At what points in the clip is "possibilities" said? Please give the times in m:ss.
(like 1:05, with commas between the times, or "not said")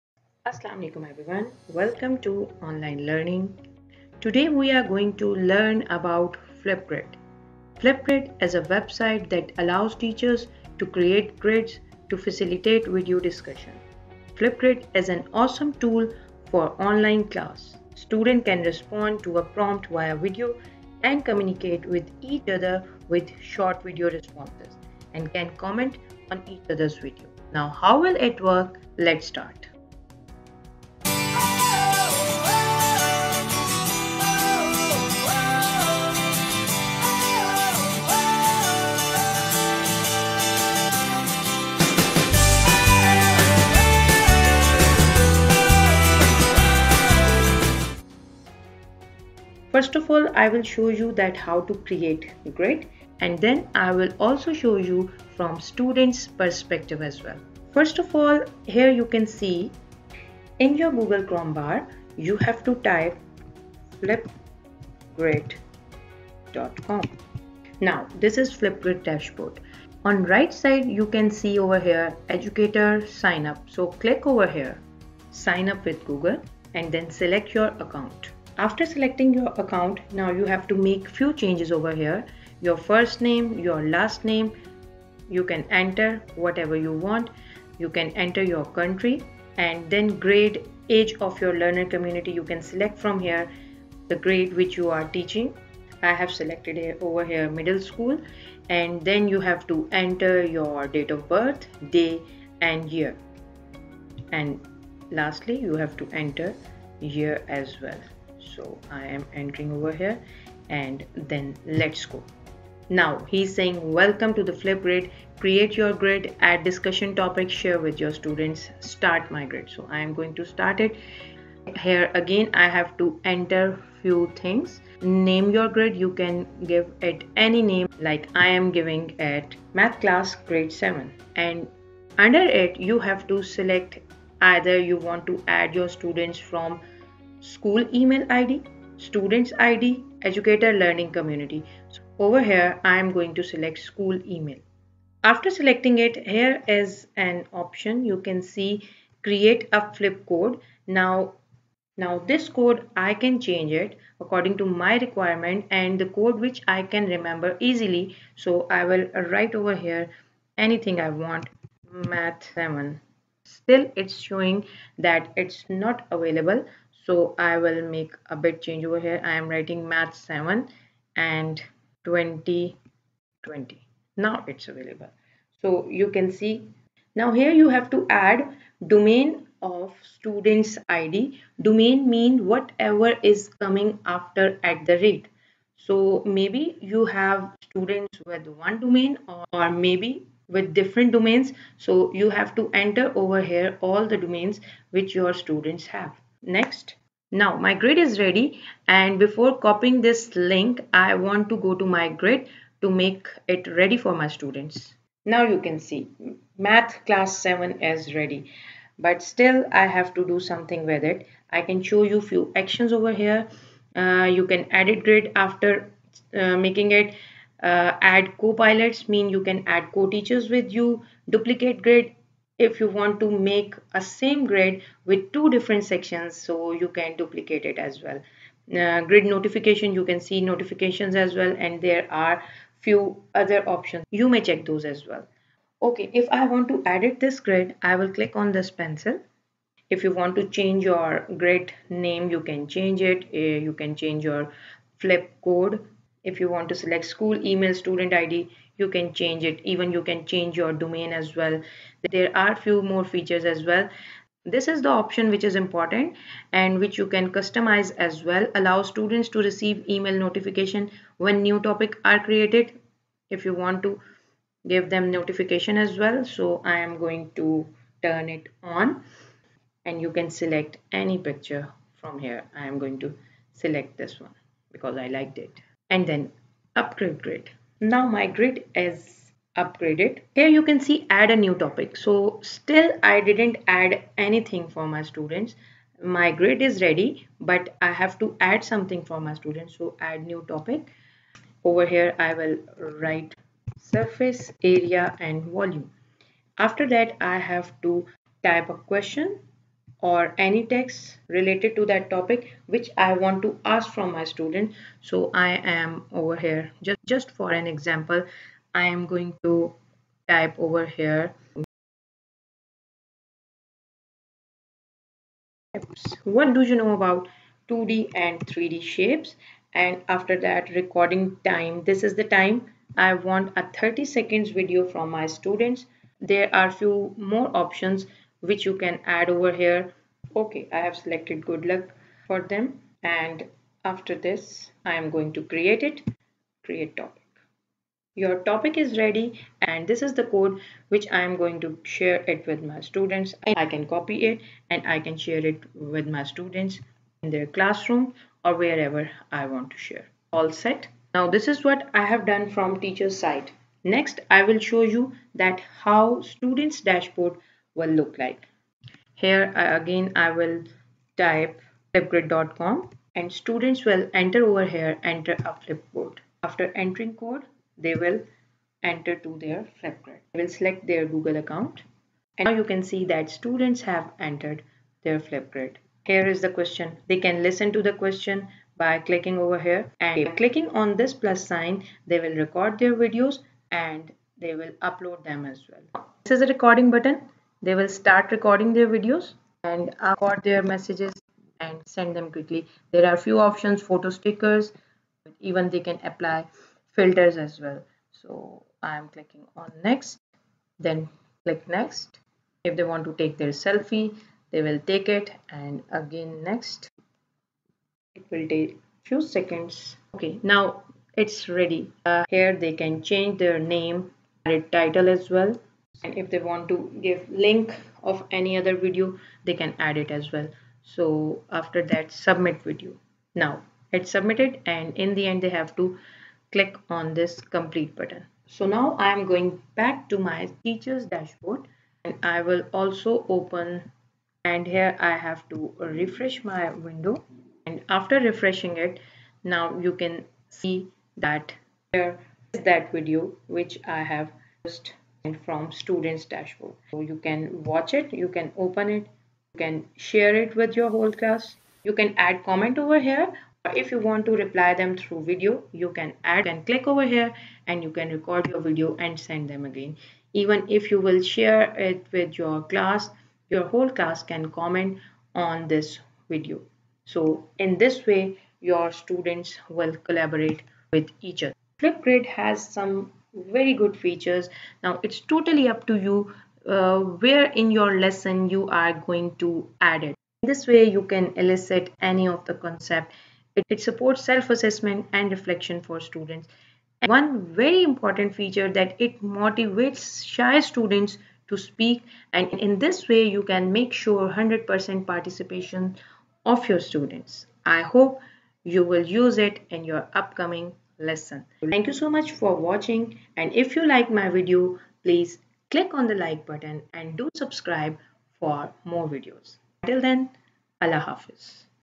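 not said.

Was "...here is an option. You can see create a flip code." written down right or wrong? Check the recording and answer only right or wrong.
right.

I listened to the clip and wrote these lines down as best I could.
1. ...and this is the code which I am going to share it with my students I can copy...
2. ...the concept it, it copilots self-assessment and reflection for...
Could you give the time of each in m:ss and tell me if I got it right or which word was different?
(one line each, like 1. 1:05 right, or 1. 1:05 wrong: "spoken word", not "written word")
1. 5:39 right
2. 8:02 wrong: "supports", not "copilots".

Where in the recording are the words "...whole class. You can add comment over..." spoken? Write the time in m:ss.
7:30.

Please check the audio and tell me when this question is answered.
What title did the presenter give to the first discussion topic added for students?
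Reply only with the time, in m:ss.
4:53.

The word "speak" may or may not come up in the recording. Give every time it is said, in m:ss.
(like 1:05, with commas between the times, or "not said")
8:11.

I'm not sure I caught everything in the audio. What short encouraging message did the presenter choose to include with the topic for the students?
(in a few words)
Good luck.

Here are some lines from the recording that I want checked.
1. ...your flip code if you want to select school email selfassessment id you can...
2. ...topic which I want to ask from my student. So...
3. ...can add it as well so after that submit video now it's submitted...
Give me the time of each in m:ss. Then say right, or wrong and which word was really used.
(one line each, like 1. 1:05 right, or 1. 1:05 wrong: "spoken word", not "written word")
1. 4:04 wrong: "student", not "selfassessment"
2. 5:02 right
3. 6:59 right.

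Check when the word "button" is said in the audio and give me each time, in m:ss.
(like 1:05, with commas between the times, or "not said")
6:26, 7:07, 8:26.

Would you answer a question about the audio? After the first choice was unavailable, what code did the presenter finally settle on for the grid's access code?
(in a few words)
math 7 2020.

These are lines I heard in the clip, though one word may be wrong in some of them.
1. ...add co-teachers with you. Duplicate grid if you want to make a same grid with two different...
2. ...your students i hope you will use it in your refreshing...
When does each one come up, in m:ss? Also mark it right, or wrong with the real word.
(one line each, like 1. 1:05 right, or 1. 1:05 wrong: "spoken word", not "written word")
1. 3:39 right
2. 8:16 wrong: "upcoming", not "refreshing".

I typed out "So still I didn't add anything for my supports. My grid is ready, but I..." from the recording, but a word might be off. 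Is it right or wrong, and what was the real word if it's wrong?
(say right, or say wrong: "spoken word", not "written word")
wrong: "students", not "supports".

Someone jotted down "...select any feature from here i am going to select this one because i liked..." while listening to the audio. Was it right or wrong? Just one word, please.
wrong.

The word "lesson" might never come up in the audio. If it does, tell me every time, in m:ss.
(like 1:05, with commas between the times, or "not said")
7:57, 8:21.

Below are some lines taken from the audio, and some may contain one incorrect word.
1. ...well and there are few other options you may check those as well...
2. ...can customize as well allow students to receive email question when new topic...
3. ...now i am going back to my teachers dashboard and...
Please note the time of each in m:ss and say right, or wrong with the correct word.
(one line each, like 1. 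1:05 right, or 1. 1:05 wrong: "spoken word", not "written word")
1. 3:51 right
2. 4:17 wrong: "notification", not "question"
3. 7:08 right.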